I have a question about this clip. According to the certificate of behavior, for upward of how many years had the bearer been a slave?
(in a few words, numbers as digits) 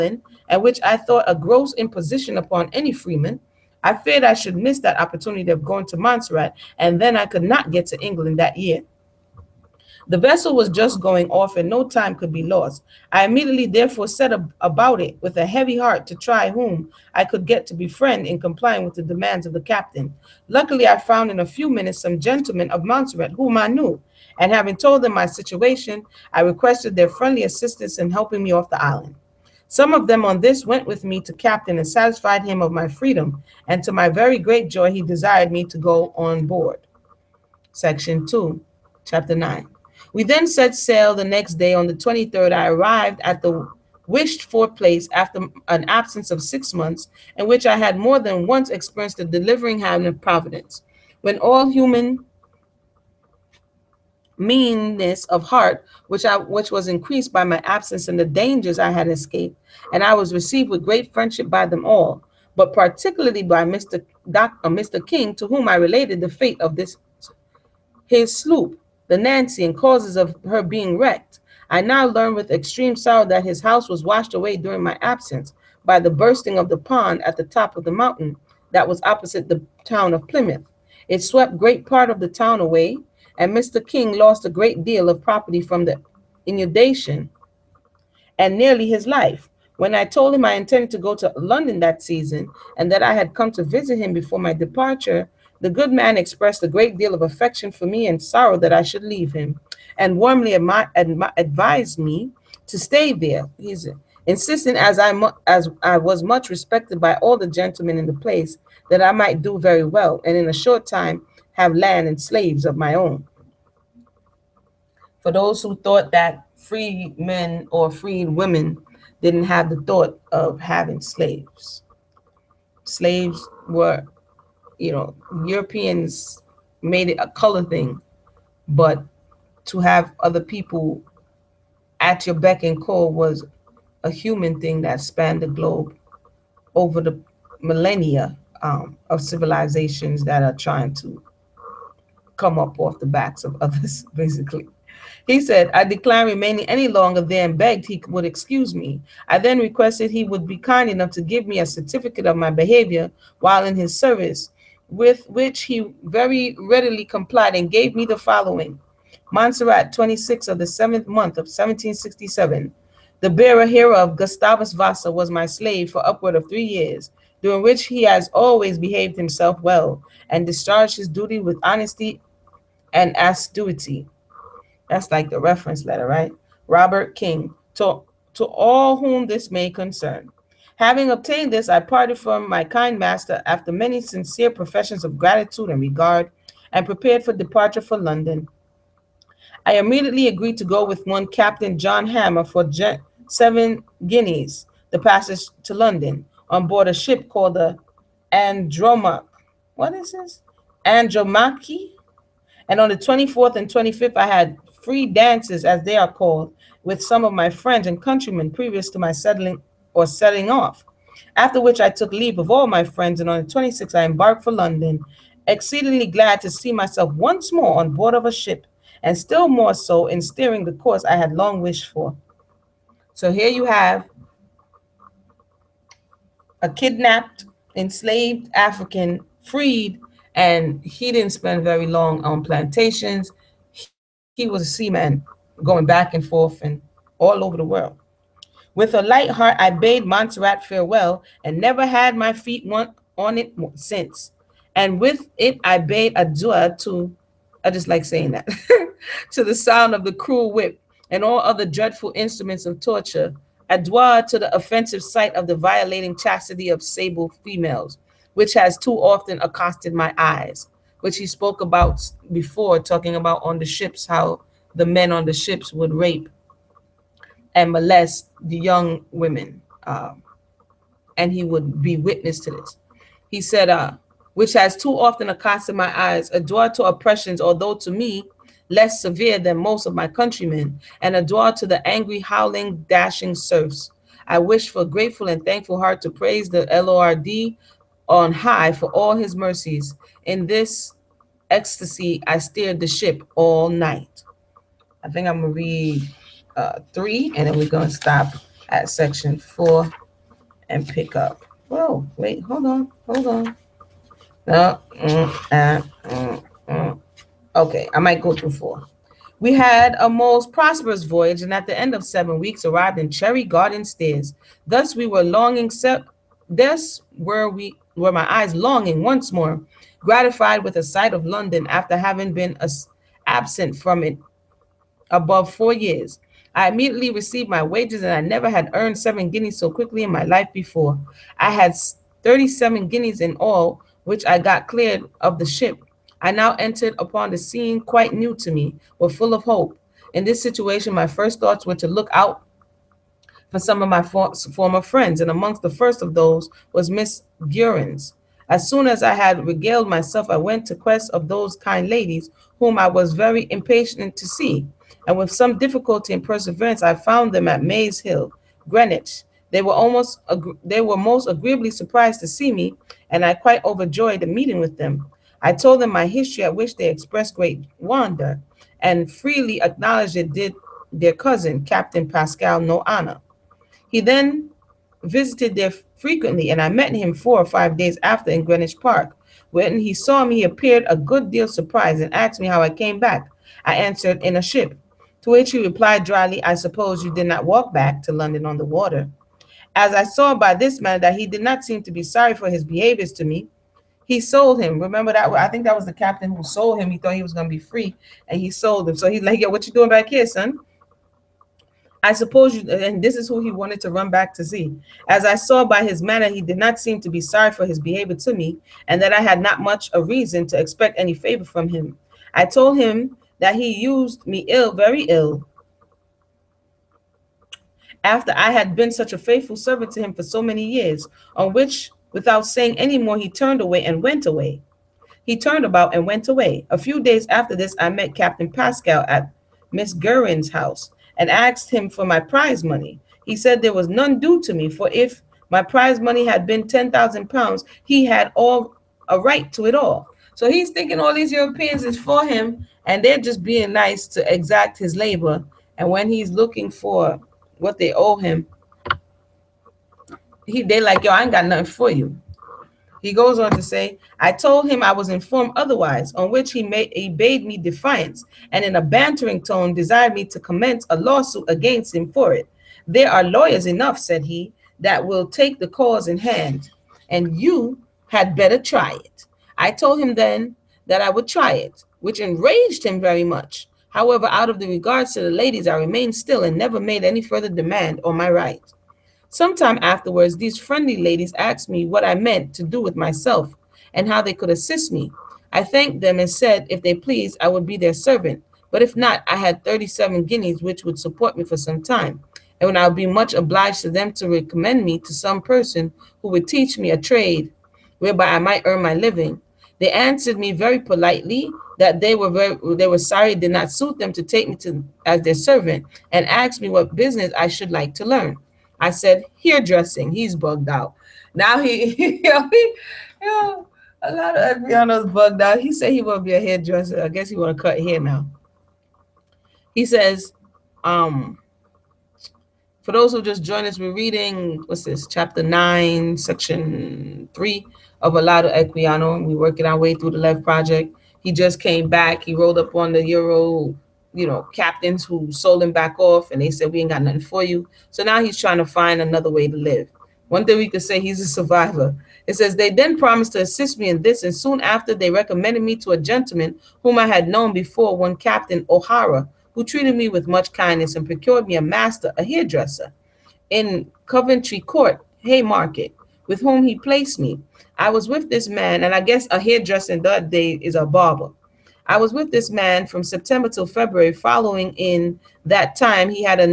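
3.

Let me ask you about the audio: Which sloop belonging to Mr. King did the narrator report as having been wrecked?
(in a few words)
Nancy.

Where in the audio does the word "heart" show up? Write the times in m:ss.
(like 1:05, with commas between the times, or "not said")
0:15, 0:55, 3:59, 4:45.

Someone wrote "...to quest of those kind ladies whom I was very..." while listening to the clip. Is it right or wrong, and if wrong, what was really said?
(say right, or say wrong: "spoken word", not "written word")
right.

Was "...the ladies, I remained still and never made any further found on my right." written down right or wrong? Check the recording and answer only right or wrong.
wrong.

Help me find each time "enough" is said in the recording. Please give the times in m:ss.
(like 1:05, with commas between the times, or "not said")
2:30, 7:43.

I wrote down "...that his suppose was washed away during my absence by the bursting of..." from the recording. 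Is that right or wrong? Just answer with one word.
wrong.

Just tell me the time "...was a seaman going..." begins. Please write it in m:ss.
3:54.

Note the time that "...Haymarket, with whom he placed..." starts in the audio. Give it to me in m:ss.
9:15.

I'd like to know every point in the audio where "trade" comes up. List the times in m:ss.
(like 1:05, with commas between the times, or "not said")
8:16.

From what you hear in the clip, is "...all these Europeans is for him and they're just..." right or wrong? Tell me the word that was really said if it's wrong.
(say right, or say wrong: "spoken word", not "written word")
right.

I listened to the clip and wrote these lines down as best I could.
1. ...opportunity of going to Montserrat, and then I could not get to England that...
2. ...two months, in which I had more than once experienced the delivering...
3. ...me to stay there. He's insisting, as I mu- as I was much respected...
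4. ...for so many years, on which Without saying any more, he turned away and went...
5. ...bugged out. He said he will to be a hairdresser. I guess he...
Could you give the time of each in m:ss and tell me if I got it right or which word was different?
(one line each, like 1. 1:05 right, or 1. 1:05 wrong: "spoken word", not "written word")
1. 0:05 right
2. 0:46 wrong: "six", not "two"
3. 1:41 right
4. 7:00 right
5. 8:35 right.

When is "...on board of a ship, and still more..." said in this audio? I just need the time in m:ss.
3:37.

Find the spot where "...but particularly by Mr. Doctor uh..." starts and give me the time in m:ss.
1:02.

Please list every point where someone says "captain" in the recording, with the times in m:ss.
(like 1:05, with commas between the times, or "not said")
0:19, 0:31, 3:11, 6:11, 6:35, 7:08, 8:54, 9:08.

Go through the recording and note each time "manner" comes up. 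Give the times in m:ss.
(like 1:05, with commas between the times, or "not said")
6:30, 6:46.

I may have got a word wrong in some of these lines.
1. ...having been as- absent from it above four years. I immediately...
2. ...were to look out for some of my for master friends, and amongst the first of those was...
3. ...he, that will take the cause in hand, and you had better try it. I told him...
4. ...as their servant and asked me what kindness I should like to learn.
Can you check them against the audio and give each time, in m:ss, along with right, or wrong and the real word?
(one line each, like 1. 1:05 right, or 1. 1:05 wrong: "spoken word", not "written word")
1. 5:21 right
2. 5:41 wrong: "former", not "master"
3. 7:44 right
4. 8:25 wrong: "business", not "kindness".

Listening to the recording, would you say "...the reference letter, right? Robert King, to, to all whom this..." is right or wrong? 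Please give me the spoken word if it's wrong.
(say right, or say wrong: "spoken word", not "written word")
right.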